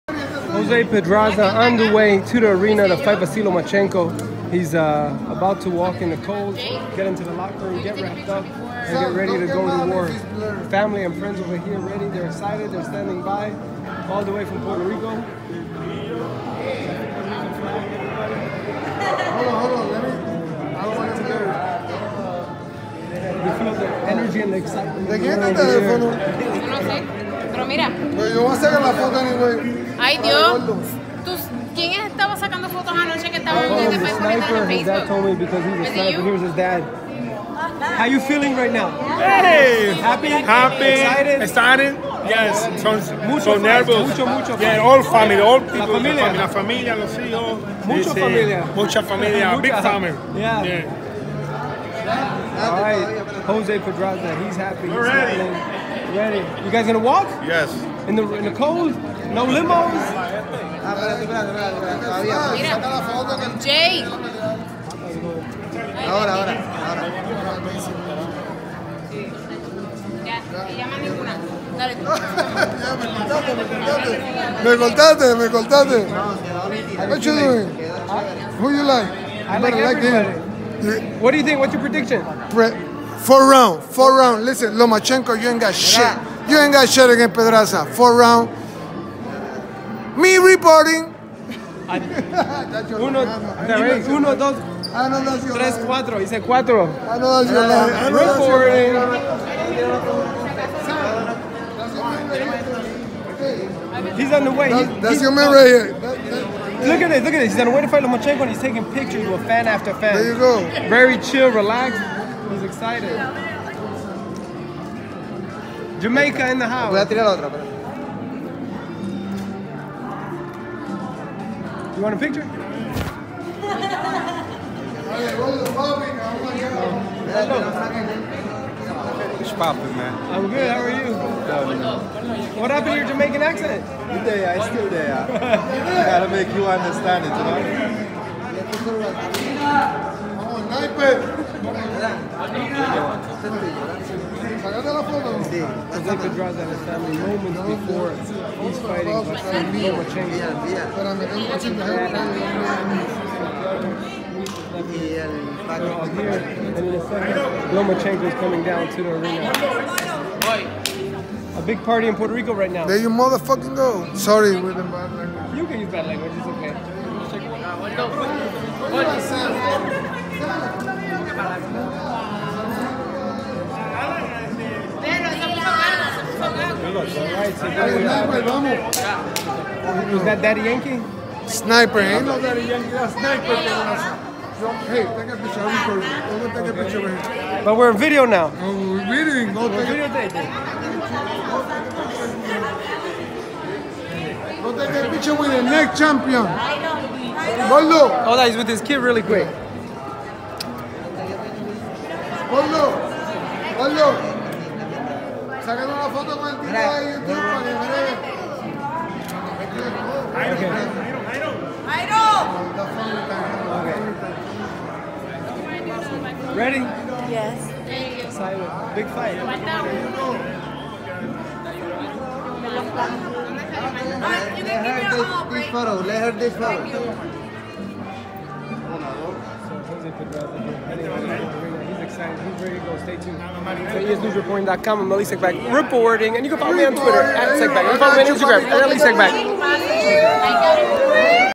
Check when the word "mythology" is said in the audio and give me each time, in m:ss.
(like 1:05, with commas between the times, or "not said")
not said.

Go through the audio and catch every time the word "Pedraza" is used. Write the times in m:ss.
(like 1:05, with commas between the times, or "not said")
0:00, 0:53, 1:27.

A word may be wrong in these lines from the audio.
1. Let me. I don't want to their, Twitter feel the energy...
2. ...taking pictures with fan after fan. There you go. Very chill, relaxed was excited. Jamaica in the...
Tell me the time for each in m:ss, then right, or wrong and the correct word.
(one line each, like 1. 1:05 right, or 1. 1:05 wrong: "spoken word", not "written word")
1. 0:19 wrong: "They", not "Twitter"
2. 1:48 right.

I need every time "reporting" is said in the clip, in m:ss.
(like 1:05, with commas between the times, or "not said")
1:30, 1:38, 3:55.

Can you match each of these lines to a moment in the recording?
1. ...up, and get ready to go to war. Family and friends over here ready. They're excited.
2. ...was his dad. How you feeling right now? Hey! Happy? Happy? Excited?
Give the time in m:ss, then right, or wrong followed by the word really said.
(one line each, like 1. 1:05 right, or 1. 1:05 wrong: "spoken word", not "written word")
1. 0:08 right
2. 0:36 right.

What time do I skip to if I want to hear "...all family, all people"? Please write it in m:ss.
0:44.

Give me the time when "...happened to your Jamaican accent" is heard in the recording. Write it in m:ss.
2:12.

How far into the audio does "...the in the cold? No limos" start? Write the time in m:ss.
0:58.